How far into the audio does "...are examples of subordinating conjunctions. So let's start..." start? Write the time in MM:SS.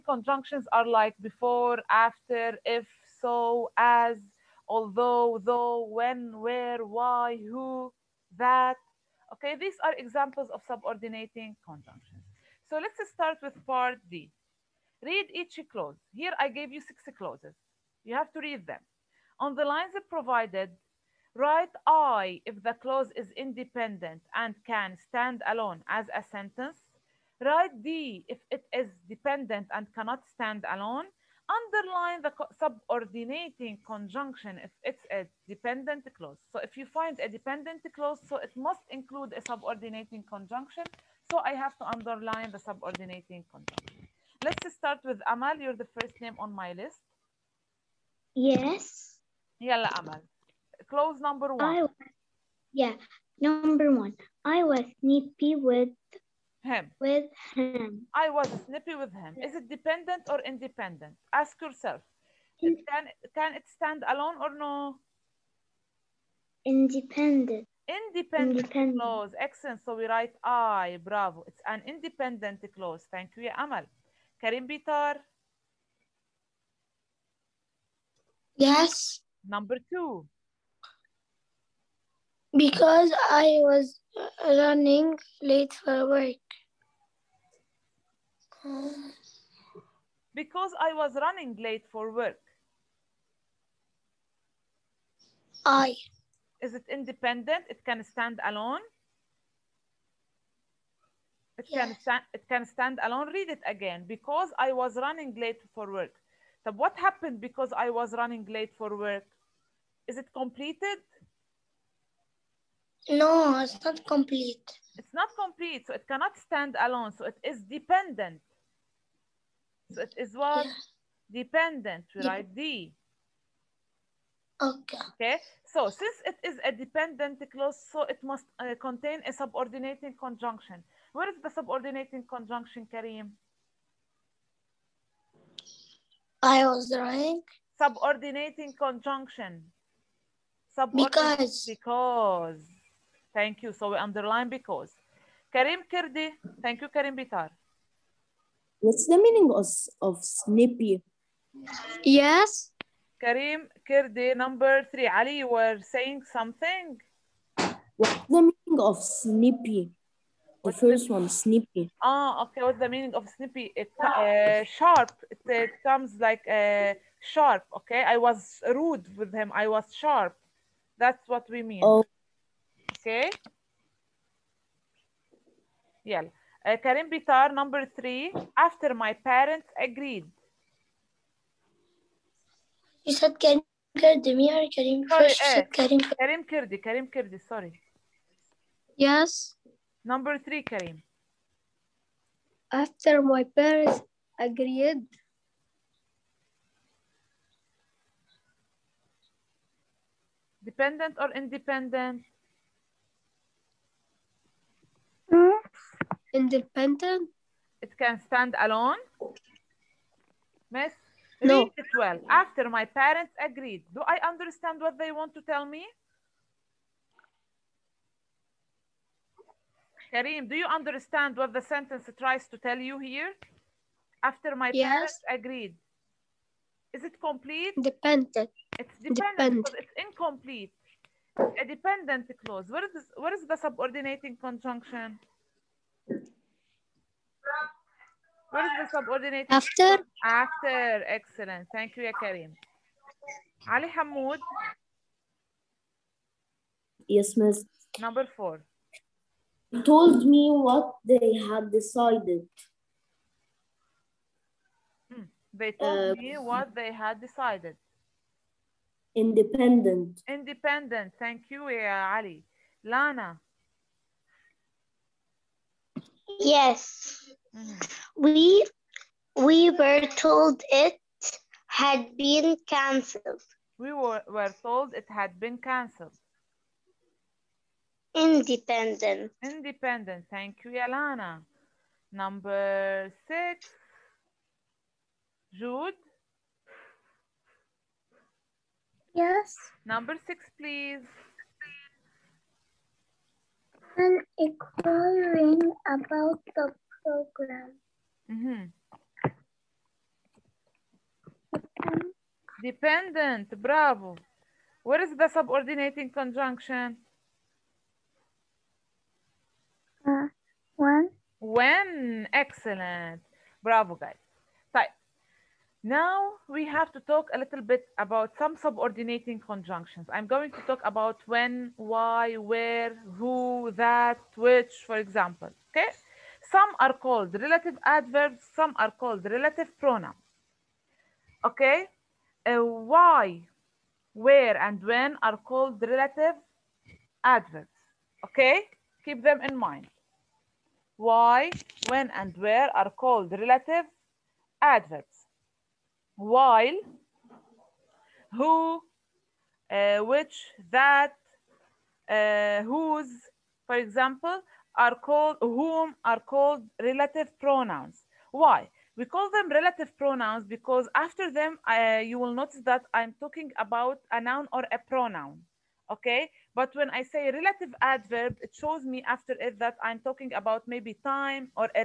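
00:09.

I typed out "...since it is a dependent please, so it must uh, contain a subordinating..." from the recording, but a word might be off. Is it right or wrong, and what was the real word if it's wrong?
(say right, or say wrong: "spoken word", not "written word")
wrong: "clause", not "please".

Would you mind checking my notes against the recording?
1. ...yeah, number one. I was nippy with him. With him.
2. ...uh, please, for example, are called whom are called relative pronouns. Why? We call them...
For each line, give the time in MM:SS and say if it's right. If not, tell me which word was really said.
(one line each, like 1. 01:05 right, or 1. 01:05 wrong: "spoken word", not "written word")
1. 00:52 right
2. 05:52 wrong: "whose", not "please".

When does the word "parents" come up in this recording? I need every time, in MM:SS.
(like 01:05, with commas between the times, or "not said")
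02:59, 03:13, 03:32, 03:44.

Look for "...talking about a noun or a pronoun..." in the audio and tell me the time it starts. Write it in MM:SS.
06:03.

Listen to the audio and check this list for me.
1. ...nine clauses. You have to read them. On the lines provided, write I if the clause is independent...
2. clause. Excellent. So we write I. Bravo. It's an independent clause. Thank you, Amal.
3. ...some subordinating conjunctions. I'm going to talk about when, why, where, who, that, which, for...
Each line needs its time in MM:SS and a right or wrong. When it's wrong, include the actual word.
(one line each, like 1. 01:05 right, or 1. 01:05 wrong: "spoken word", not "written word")
1. 00:16 wrong: "six", not "nine"
2. 01:08 right
3. 05:18 right.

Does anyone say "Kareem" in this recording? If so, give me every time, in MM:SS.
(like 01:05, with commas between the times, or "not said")
02:12, 03:40.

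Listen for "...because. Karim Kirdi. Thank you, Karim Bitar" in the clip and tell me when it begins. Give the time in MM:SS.
02:24.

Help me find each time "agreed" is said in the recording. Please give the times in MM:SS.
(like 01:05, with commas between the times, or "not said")
02:59, 03:14, 03:33, 03:45.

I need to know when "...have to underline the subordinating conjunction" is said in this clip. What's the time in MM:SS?
00:41.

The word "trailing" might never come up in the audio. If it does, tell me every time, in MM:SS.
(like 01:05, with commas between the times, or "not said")
not said.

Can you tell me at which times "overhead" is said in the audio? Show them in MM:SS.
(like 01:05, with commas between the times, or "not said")
not said.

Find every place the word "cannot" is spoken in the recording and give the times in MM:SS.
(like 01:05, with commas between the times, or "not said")
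00:29, 01:56.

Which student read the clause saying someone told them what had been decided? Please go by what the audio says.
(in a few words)
Ali Hamoud.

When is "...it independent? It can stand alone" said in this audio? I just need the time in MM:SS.
01:36.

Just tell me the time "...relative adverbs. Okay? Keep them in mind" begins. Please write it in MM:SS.
05:35.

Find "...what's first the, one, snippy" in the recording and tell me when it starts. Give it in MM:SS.
02:40.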